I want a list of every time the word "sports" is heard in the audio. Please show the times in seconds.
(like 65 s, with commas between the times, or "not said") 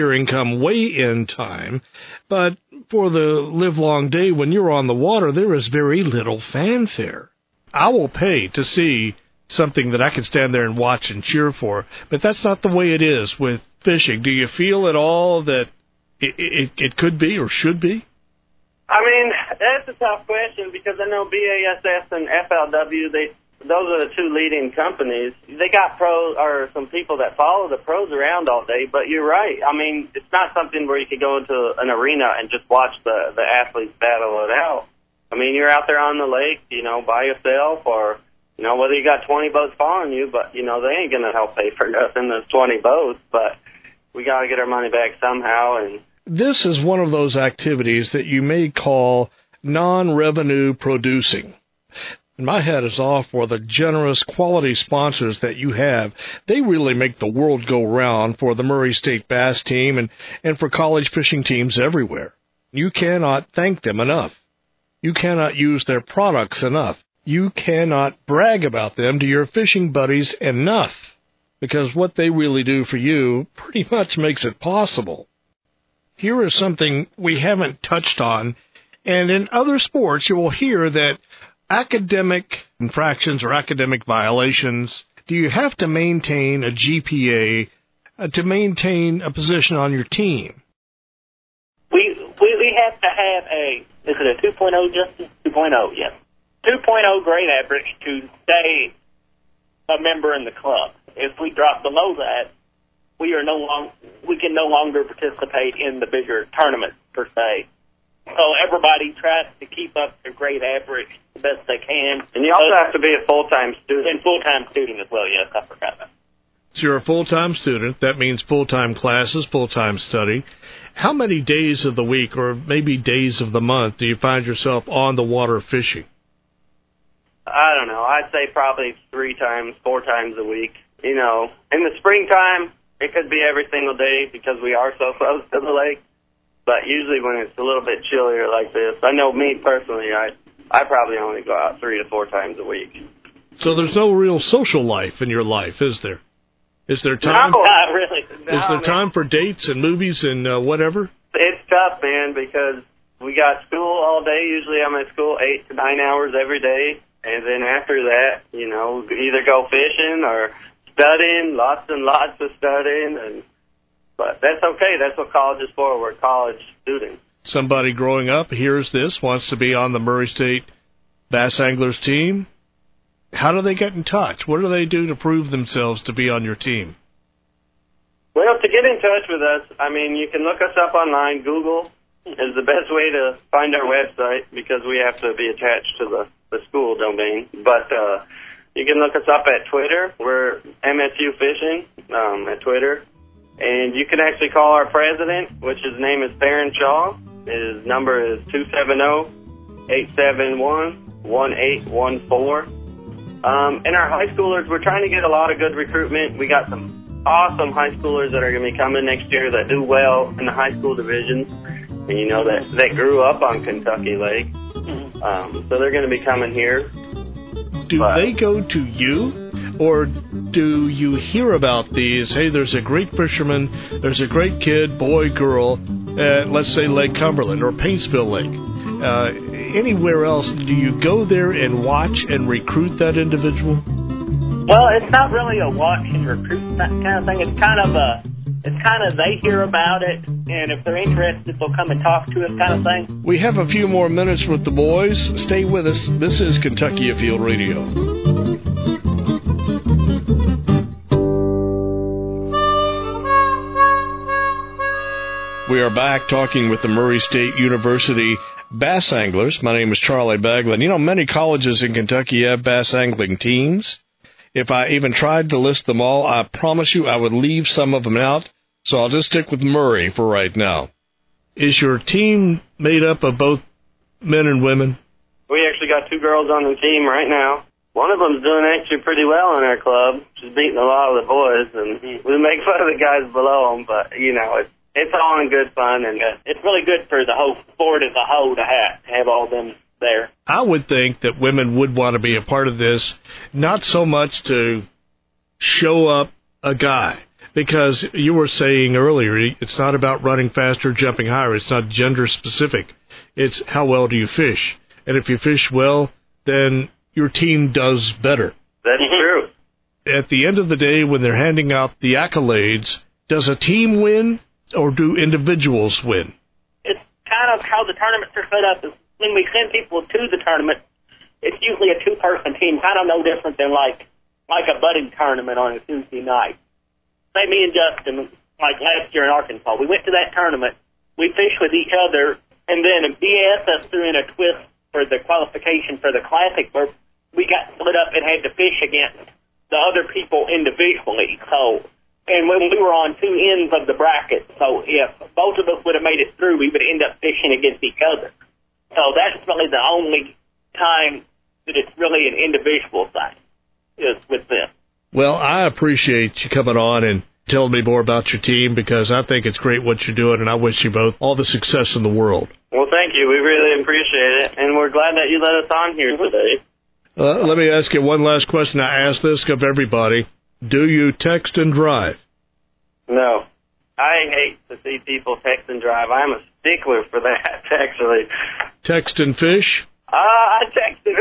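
79 s, 287 s.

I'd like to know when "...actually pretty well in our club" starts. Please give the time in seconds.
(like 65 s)
278 s.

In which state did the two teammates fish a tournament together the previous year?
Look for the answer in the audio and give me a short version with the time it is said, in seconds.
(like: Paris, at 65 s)
Arkansas, at 329 s.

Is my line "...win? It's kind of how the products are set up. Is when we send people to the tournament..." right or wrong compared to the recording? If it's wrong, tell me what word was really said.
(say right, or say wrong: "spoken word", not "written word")
wrong: "tournaments", not "products".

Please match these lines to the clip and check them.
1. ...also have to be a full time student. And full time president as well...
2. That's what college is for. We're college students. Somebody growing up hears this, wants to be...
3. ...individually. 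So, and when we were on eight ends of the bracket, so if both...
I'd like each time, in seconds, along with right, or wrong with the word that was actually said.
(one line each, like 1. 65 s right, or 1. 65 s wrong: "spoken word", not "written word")
1. 112 s wrong: "student", not "president"
2. 165 s right
3. 340 s wrong: "two", not "eight".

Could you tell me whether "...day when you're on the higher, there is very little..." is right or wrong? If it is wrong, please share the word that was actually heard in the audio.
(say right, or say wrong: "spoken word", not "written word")
wrong: "water", not "higher".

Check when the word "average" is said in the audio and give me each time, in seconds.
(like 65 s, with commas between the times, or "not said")
97 s, 110 s.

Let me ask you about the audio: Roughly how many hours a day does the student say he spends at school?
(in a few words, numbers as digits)
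8 to 9 hours.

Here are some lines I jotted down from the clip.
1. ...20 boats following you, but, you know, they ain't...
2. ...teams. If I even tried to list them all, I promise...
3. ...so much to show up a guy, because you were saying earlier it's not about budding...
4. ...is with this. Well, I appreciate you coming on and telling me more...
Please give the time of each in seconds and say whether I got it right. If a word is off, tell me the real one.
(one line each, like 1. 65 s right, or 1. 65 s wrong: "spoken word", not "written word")
1. 39 s right
2. 263 s right
3. 293 s wrong: "running", not "budding"
4. 353 s right.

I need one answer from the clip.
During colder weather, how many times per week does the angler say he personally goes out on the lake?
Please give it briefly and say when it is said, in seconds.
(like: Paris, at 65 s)
3 to 4, at 141 s.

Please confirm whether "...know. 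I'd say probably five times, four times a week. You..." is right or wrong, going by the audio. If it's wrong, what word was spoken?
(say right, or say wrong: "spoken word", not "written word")
wrong: "three", not "five".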